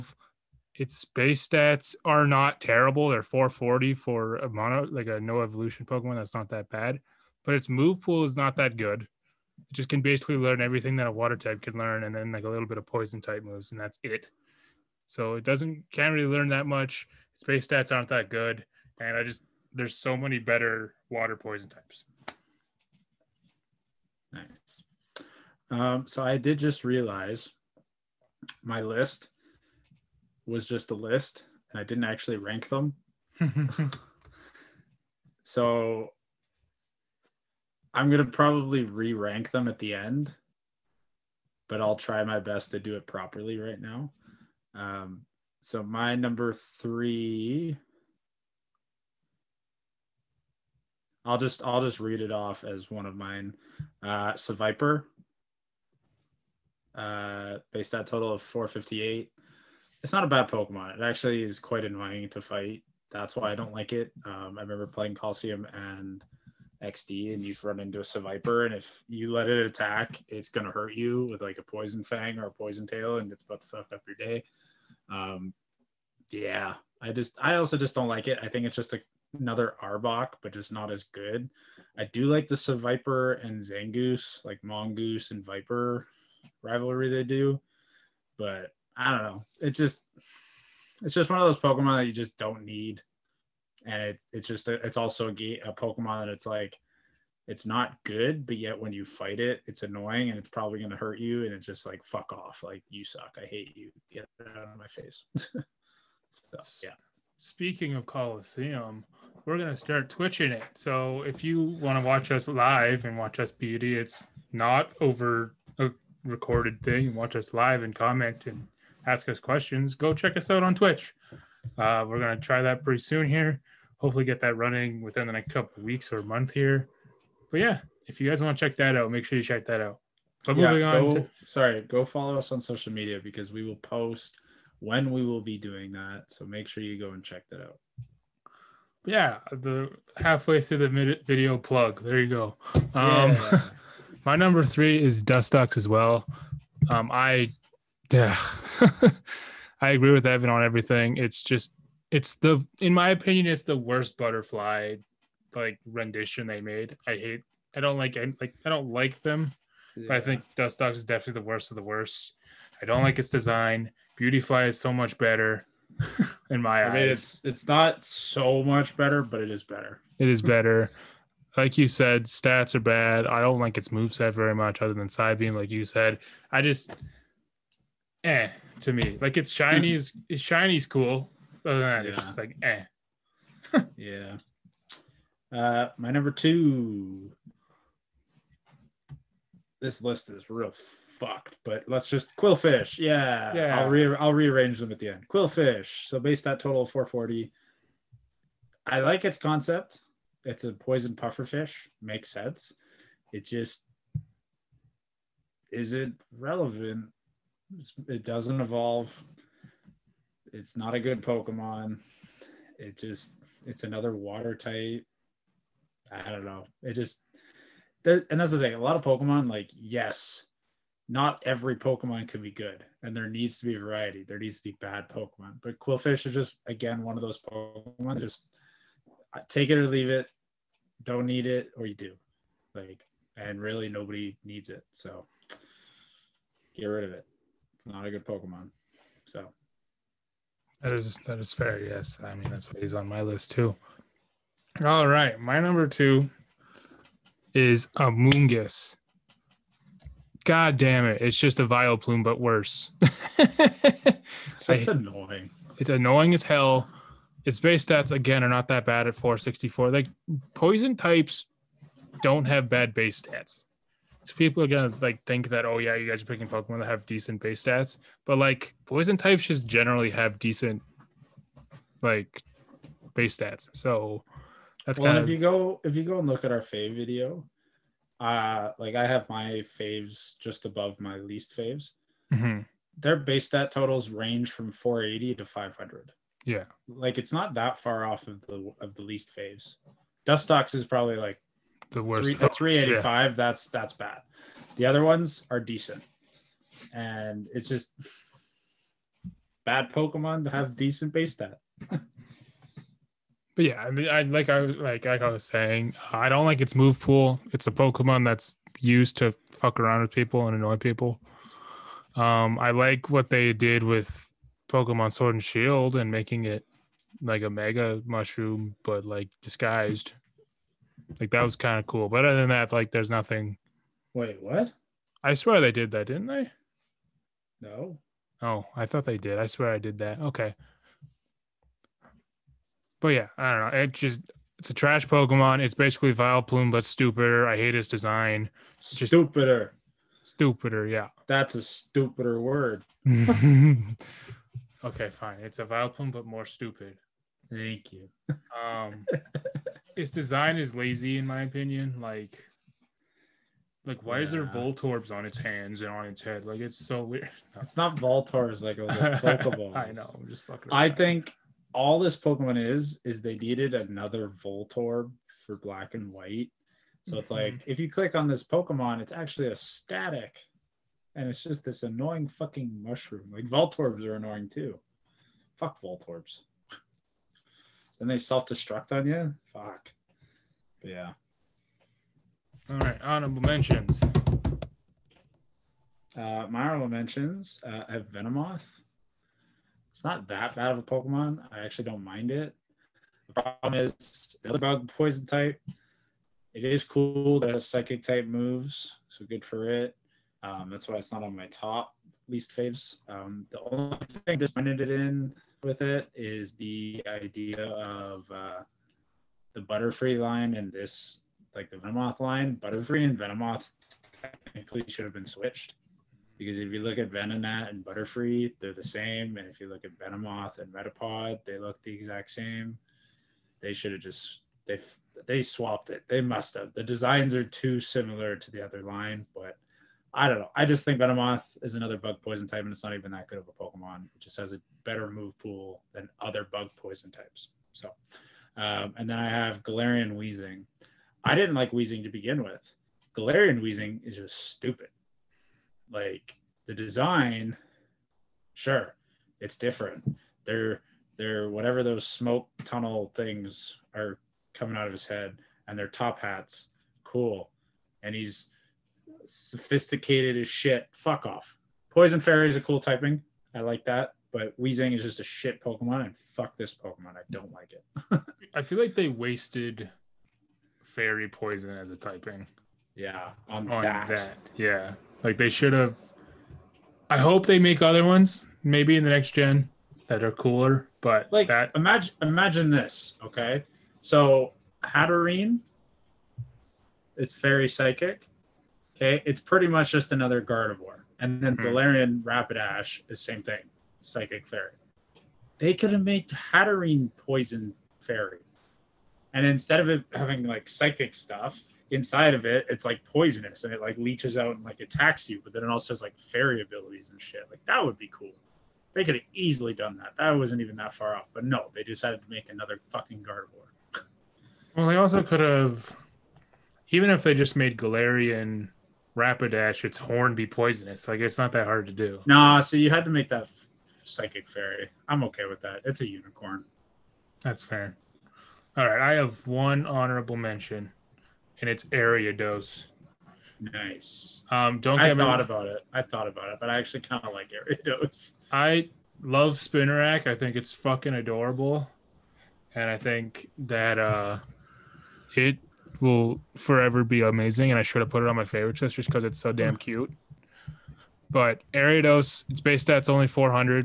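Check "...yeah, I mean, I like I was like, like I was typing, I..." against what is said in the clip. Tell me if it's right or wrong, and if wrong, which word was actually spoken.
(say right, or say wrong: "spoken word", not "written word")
wrong: "saying", not "typing".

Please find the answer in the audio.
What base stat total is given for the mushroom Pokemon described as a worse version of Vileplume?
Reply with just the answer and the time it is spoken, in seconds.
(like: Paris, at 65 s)
464, at 259 s.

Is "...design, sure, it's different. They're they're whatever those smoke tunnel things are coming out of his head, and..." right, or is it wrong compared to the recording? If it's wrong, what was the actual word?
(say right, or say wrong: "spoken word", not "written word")
right.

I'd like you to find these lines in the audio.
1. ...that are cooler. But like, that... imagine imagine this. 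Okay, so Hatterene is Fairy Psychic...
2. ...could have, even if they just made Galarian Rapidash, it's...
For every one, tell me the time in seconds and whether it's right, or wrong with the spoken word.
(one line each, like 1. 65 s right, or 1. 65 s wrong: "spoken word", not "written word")
1. 480 s right
2. 515 s right.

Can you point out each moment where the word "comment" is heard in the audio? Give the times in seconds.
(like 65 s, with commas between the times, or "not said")
117 s.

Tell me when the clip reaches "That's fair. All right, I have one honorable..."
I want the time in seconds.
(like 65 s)
527 s.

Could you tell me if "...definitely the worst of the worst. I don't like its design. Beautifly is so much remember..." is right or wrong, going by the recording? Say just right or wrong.
wrong.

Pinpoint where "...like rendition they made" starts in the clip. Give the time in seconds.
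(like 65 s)
155 s.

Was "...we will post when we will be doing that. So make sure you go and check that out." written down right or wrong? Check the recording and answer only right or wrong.
right.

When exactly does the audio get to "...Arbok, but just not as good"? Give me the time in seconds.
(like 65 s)
79 s.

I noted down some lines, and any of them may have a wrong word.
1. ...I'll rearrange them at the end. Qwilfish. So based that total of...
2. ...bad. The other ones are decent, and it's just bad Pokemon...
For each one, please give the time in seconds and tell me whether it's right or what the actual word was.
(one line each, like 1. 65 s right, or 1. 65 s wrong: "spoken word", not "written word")
1. 194 s right
2. 293 s right.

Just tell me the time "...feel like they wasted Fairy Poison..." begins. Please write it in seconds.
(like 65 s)
468 s.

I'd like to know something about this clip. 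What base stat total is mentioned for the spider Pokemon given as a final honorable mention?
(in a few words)
400.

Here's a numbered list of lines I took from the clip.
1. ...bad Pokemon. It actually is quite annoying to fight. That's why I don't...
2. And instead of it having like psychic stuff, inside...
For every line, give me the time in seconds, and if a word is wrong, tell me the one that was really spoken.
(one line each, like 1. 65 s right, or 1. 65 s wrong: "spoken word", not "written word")
1. 60 s right
2. 499 s right.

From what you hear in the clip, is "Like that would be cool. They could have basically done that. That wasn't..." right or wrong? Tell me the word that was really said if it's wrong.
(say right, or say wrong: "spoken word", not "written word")
wrong: "easily", not "basically".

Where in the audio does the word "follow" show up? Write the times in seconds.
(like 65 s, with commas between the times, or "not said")
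132 s.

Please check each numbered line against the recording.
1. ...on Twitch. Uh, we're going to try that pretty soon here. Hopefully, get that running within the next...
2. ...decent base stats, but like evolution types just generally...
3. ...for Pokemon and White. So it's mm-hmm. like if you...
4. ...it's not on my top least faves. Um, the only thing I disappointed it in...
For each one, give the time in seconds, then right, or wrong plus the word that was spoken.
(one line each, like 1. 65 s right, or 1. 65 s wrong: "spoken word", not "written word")
1. 120 s right
2. 267 s wrong: "poison", not "evolution"
3. 365 s wrong: "Black", not "Pokemon"
4. 400 s right.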